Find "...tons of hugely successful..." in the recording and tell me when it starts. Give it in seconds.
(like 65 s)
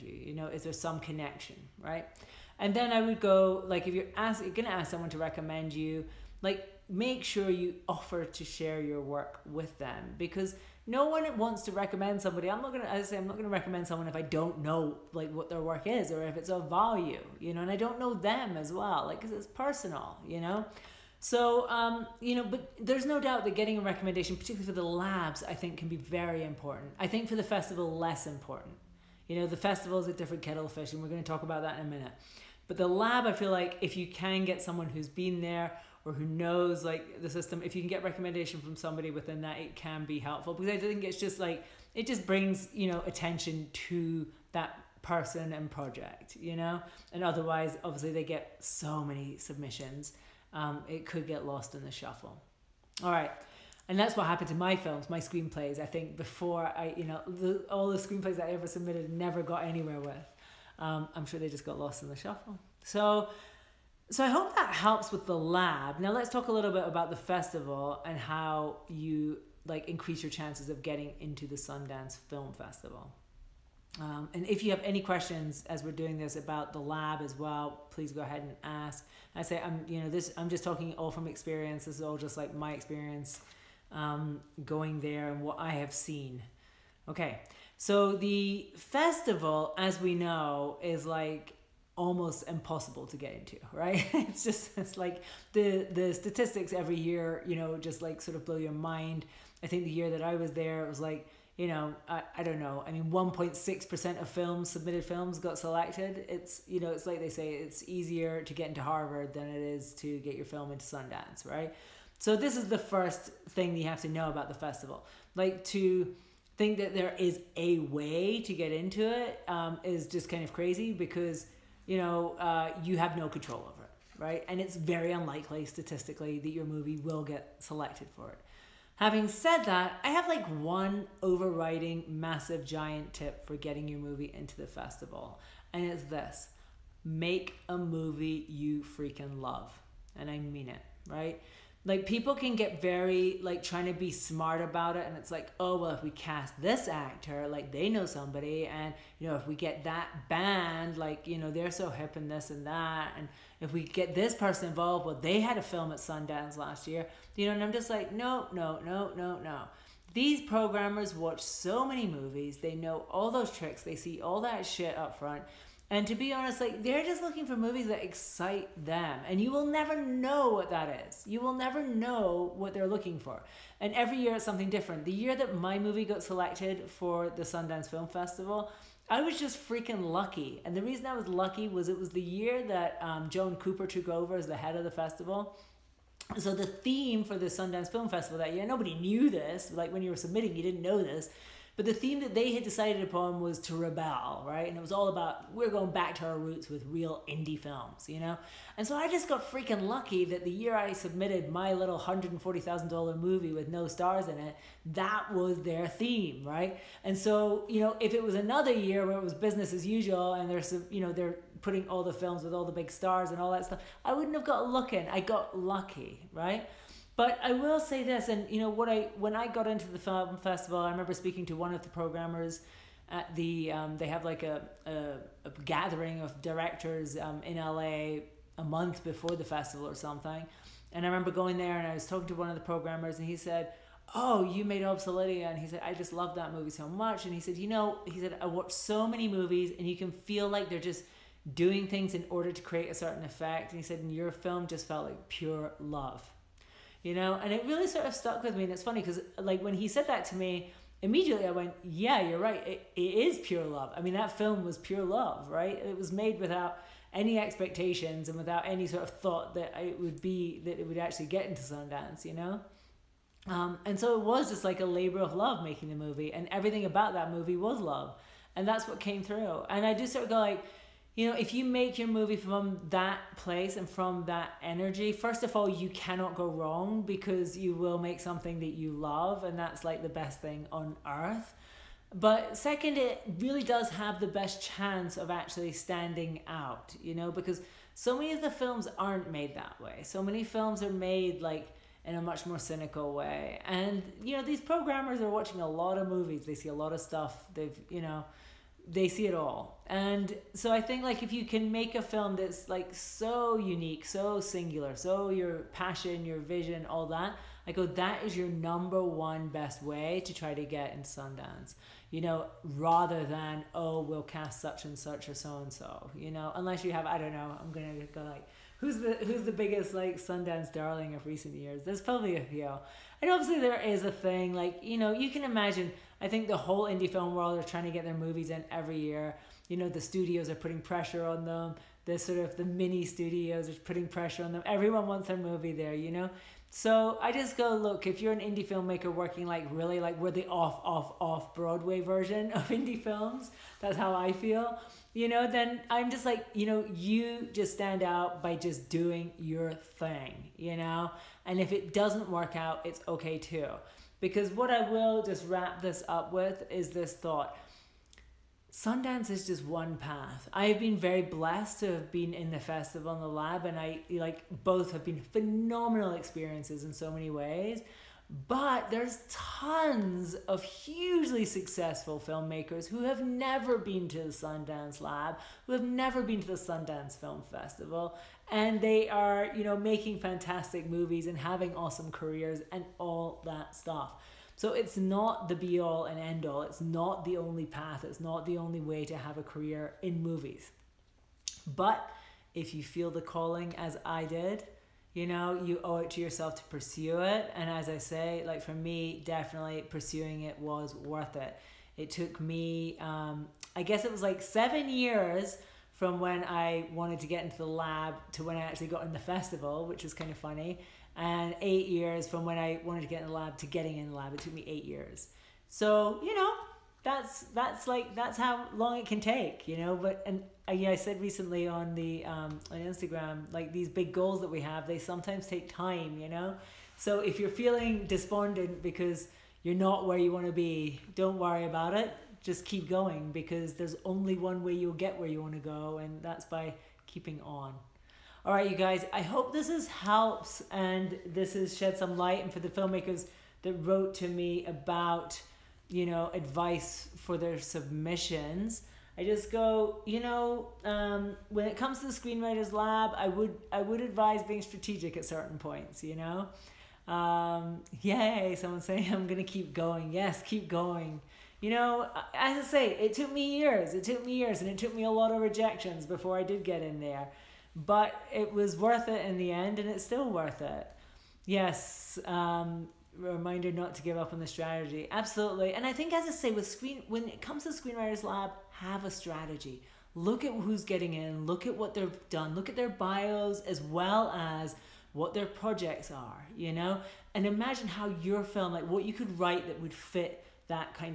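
369 s.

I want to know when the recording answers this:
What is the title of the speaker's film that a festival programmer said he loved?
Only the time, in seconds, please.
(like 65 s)
234 s.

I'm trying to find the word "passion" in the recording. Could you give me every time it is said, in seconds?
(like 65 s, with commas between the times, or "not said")
305 s.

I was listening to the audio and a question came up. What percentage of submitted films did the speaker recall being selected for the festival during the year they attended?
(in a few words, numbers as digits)
1.6%.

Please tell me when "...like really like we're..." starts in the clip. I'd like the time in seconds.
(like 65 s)
339 s.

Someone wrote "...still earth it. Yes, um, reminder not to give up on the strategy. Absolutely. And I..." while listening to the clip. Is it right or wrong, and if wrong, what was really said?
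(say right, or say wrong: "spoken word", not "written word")
wrong: "worth", not "earth".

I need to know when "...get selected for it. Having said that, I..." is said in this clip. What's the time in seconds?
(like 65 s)
127 s.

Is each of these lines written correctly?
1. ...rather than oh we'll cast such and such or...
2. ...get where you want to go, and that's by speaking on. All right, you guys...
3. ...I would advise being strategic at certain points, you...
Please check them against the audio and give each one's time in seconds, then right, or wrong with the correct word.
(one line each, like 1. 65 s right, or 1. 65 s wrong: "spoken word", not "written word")
1. 312 s right
2. 435 s wrong: "keeping", not "speaking"
3. 453 s right.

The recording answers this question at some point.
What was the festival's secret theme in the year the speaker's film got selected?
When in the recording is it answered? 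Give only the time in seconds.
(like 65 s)
193 s.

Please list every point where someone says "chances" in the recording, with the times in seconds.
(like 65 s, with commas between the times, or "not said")
70 s, 284 s.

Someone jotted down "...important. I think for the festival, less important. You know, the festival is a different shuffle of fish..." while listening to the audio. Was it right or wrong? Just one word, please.
wrong.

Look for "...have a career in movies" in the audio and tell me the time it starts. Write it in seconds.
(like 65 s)
389 s.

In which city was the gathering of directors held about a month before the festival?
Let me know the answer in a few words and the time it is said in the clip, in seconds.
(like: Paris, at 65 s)
LA, at 227 s.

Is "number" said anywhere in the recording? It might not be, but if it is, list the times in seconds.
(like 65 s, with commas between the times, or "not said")
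308 s.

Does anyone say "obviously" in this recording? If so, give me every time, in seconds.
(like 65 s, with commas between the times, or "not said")
47 s, 323 s.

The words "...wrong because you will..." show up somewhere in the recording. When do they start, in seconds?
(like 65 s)
276 s.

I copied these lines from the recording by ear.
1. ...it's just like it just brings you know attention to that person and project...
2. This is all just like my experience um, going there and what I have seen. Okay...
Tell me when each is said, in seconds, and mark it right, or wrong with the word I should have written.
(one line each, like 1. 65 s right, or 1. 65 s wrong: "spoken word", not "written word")
1. 41 s right
2. 81 s right.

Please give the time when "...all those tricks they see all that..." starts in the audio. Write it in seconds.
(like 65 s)
163 s.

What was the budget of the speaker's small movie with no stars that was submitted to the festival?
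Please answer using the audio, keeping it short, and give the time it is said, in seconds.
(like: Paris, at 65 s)
$140,000, at 201 s.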